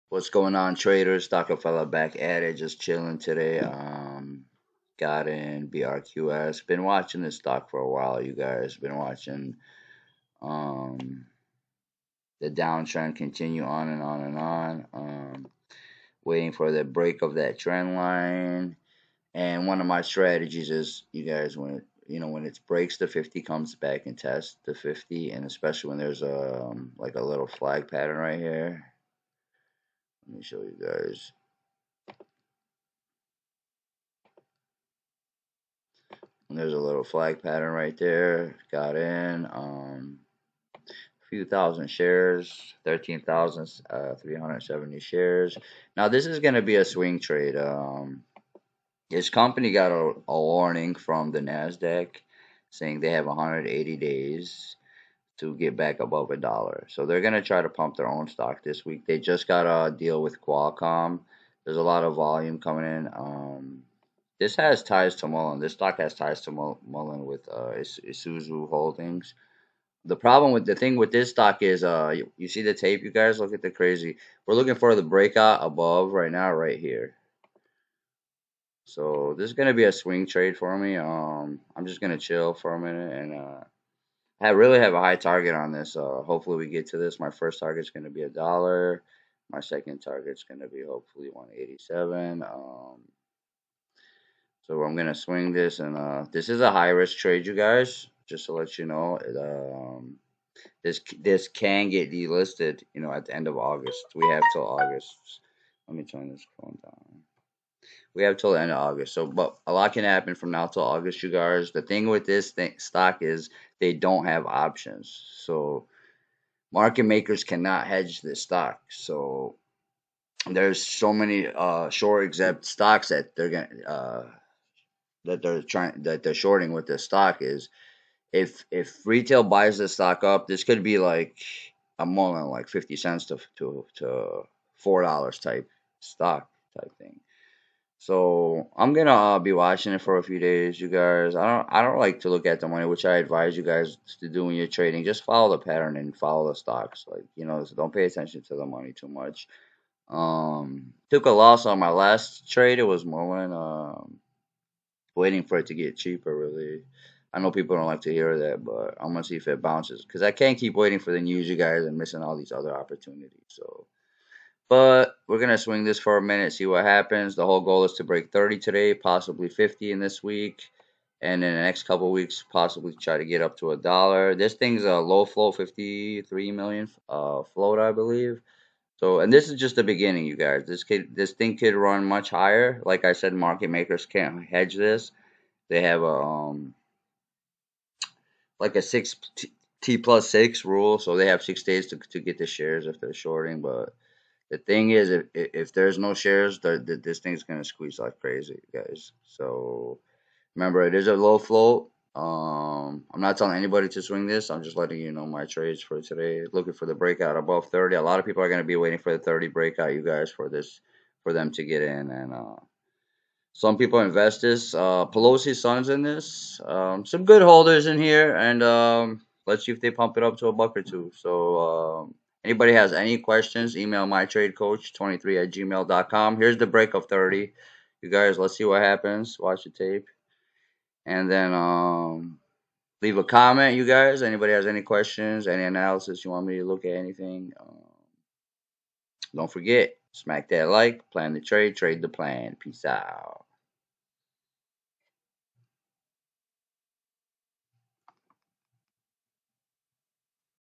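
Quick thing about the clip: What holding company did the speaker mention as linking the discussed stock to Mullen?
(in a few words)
Isuzu Holdings.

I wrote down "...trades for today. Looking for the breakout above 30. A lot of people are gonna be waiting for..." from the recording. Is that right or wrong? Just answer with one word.
right.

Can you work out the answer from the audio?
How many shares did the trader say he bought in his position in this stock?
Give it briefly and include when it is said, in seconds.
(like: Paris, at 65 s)
13,370, at 42 s.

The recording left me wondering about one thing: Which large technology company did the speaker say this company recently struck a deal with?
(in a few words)
Qualcomm.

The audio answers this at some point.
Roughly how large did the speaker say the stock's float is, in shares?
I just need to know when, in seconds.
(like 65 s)
175 s.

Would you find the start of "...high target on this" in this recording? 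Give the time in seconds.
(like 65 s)
84 s.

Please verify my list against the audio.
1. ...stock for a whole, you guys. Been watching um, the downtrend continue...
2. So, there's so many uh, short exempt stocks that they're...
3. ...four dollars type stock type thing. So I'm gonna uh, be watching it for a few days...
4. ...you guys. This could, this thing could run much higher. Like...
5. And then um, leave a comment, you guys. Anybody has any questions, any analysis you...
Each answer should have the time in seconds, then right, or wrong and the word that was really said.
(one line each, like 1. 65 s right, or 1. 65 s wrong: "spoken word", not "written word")
1. 7 s wrong: "while", not "whole"
2. 118 s right
3. 134 s right
4. 180 s right
5. 231 s right.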